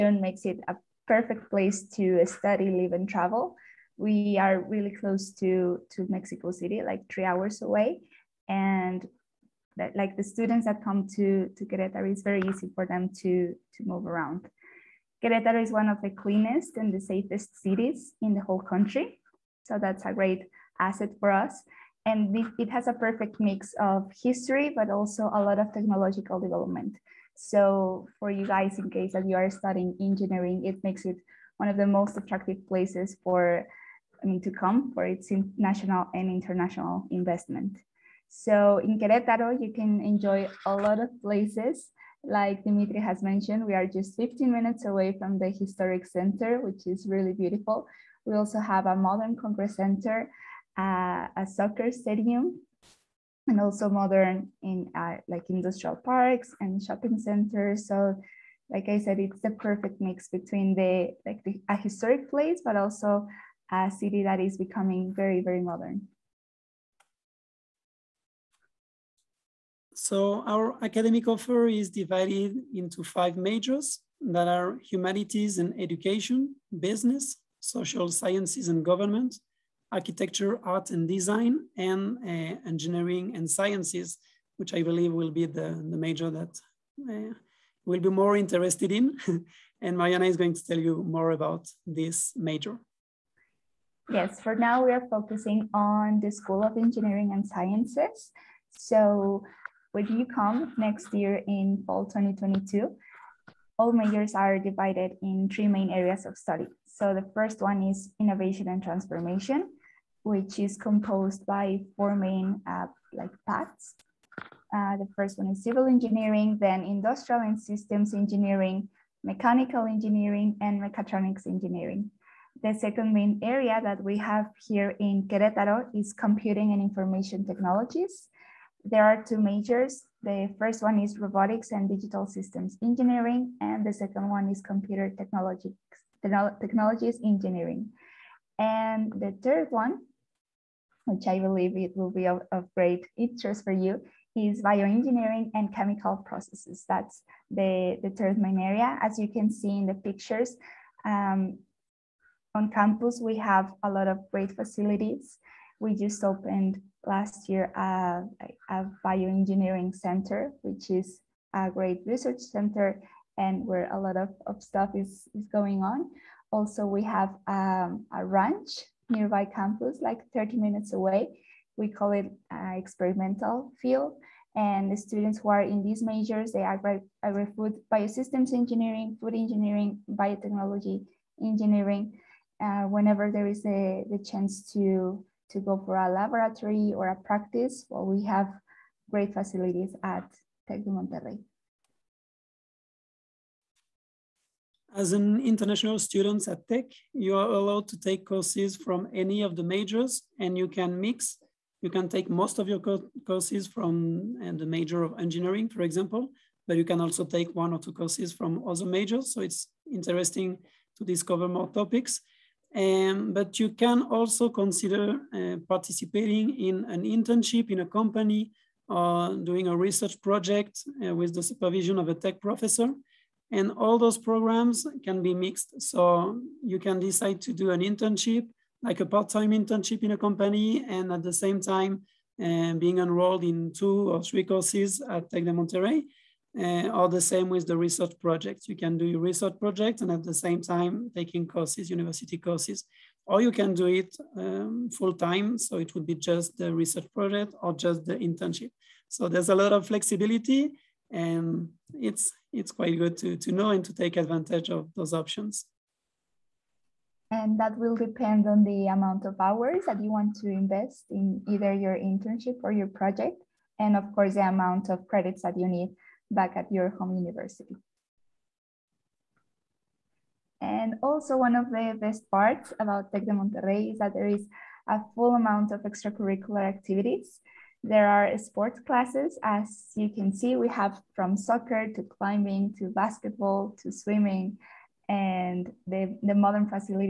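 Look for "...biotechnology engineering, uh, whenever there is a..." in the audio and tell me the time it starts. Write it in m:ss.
3:00.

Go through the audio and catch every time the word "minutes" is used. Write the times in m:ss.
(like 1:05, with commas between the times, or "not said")
0:44, 2:50.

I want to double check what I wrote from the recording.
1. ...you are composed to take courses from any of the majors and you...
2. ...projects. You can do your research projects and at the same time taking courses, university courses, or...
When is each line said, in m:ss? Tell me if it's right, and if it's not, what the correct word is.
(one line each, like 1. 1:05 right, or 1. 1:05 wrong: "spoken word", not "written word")
1. 3:17 wrong: "allowed", not "composed"
2. 3:58 right.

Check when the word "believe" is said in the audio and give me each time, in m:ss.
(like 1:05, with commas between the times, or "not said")
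1:24, 2:21.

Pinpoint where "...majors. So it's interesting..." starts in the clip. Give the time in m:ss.
3:28.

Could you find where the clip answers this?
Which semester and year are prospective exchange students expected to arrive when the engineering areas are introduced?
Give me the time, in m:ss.
1:41.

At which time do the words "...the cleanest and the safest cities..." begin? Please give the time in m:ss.
0:16.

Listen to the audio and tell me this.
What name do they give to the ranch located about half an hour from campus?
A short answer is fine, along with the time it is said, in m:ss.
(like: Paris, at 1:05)
experimental field, at 2:52.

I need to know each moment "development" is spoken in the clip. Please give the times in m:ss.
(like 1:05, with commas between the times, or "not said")
0:26.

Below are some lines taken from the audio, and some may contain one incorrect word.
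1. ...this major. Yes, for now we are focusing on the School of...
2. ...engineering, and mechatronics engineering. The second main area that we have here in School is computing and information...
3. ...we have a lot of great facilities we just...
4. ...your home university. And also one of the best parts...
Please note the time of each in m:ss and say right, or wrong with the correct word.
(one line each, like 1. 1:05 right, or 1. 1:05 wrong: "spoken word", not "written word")
1. 1:31 right
2. 1:59 wrong: "Querétaro", not "School"
3. 2:33 right
4. 4:26 right.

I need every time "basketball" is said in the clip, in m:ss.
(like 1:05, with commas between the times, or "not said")
4:42.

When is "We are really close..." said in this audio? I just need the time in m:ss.
0:03.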